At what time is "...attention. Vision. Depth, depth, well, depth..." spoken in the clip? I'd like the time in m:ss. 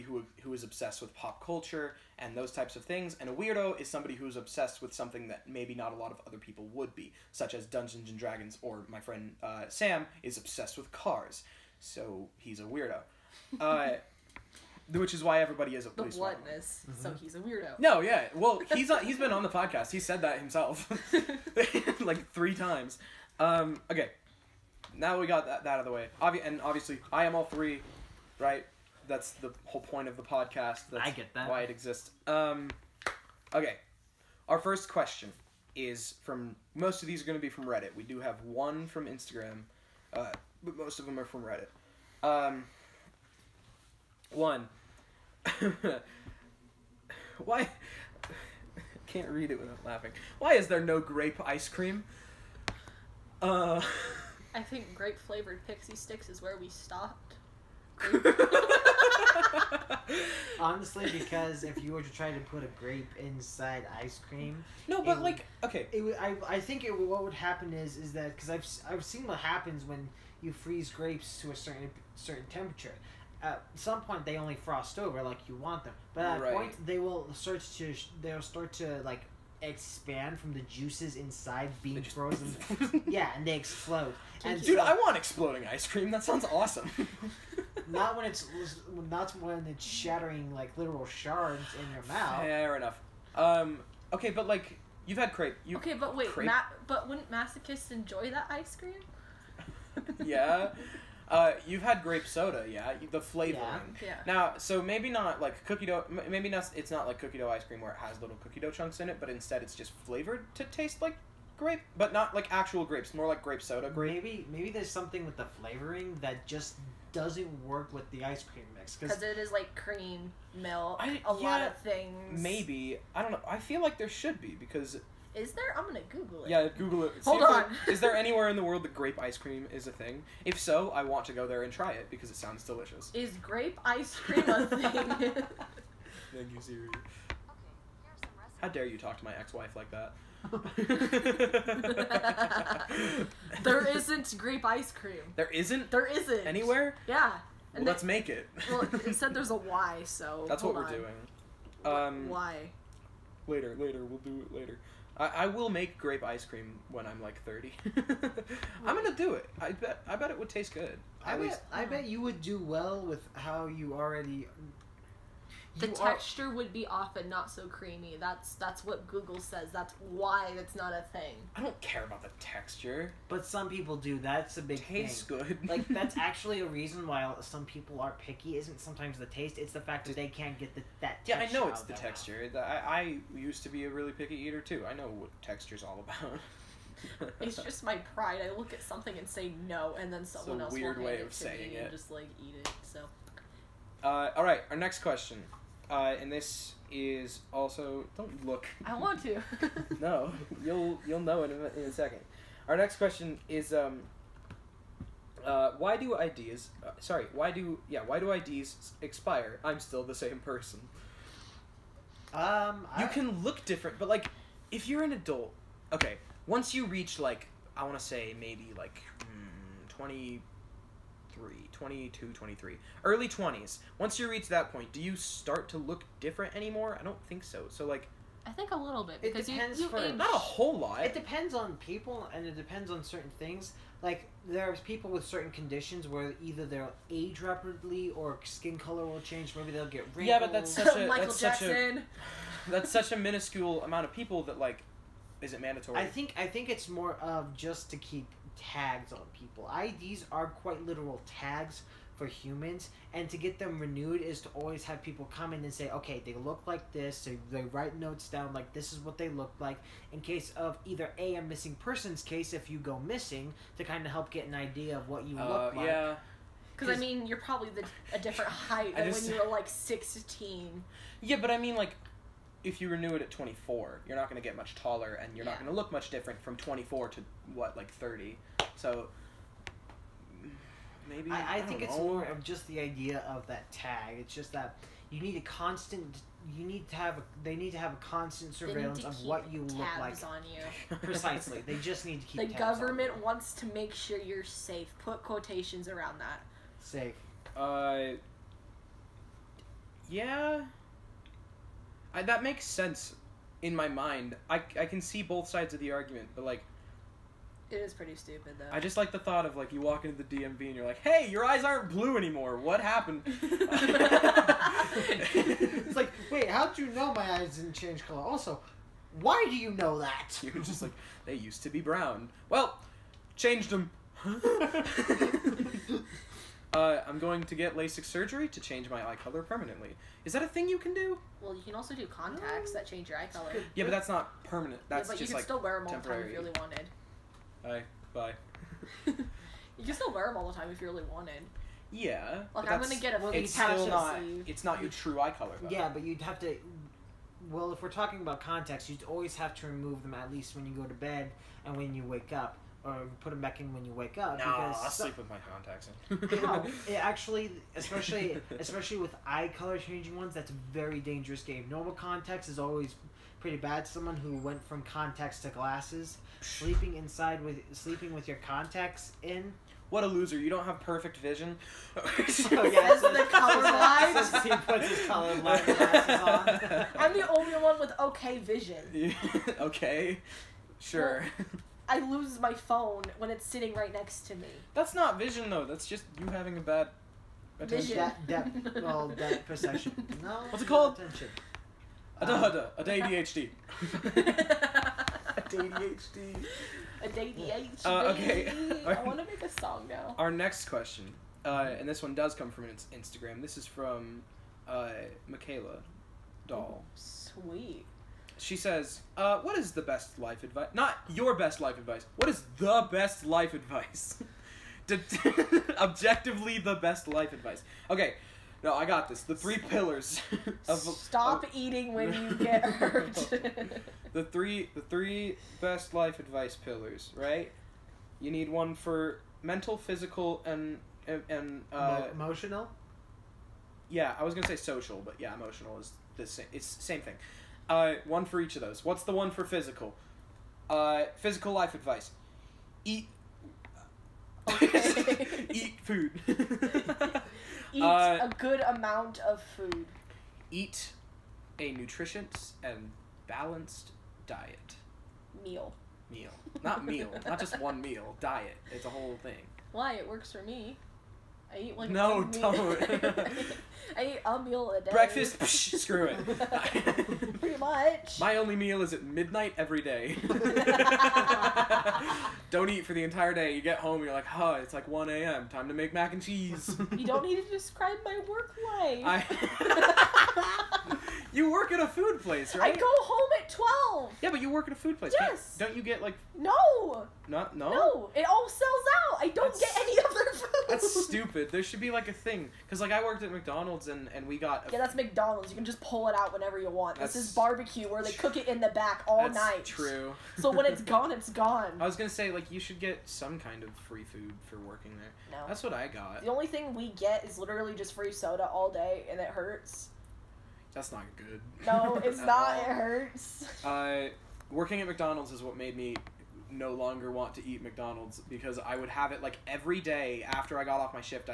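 6:27.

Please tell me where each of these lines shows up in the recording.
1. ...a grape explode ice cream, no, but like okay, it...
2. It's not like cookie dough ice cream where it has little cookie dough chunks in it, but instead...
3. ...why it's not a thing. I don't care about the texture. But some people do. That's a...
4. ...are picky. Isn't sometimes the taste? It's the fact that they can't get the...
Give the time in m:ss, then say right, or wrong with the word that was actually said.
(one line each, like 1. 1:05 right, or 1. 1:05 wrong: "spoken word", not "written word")
1. 1:02 wrong: "inside", not "explode"
2. 1:46 right
3. 2:50 right
4. 2:58 right.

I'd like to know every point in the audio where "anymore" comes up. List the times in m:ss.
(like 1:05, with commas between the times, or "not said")
3:46, 5:12.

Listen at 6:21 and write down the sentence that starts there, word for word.
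Well, I lose my phone when it's sitting right next to me.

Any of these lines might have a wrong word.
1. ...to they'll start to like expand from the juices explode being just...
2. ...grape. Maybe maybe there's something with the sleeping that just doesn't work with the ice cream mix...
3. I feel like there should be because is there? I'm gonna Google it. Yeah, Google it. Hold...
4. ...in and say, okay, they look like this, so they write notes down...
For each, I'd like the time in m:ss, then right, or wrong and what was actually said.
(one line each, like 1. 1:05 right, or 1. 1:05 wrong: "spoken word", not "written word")
1. 1:17 wrong: "inside", not "explode"
2. 1:53 wrong: "flavoring", not "sleeping"
3. 2:03 right
4. 4:15 right.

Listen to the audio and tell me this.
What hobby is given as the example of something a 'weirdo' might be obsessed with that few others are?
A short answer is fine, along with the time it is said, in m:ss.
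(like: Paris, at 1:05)
Dungeons and Dragons, at 0:07.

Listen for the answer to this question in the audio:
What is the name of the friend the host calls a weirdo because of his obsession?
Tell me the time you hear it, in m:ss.
0:09.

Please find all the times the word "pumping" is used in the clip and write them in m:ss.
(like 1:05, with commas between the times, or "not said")
not said.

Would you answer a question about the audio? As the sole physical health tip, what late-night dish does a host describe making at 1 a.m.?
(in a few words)
mac and cheese.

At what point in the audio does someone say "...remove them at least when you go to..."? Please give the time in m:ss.
5:49.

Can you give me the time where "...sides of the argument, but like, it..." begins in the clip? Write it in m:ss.
5:05.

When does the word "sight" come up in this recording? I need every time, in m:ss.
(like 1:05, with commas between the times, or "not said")
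not said.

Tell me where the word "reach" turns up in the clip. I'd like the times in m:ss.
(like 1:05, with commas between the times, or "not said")
3:36, 3:44.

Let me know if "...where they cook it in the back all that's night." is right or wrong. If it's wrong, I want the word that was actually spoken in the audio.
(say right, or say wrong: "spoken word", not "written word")
right.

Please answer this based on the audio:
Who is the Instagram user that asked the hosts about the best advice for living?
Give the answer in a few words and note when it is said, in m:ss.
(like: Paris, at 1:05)
Michaela Doll, at 6:45.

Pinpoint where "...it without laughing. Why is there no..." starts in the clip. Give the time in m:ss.
0:49.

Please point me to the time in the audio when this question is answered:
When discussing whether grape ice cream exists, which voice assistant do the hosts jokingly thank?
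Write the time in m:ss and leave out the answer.
2:16.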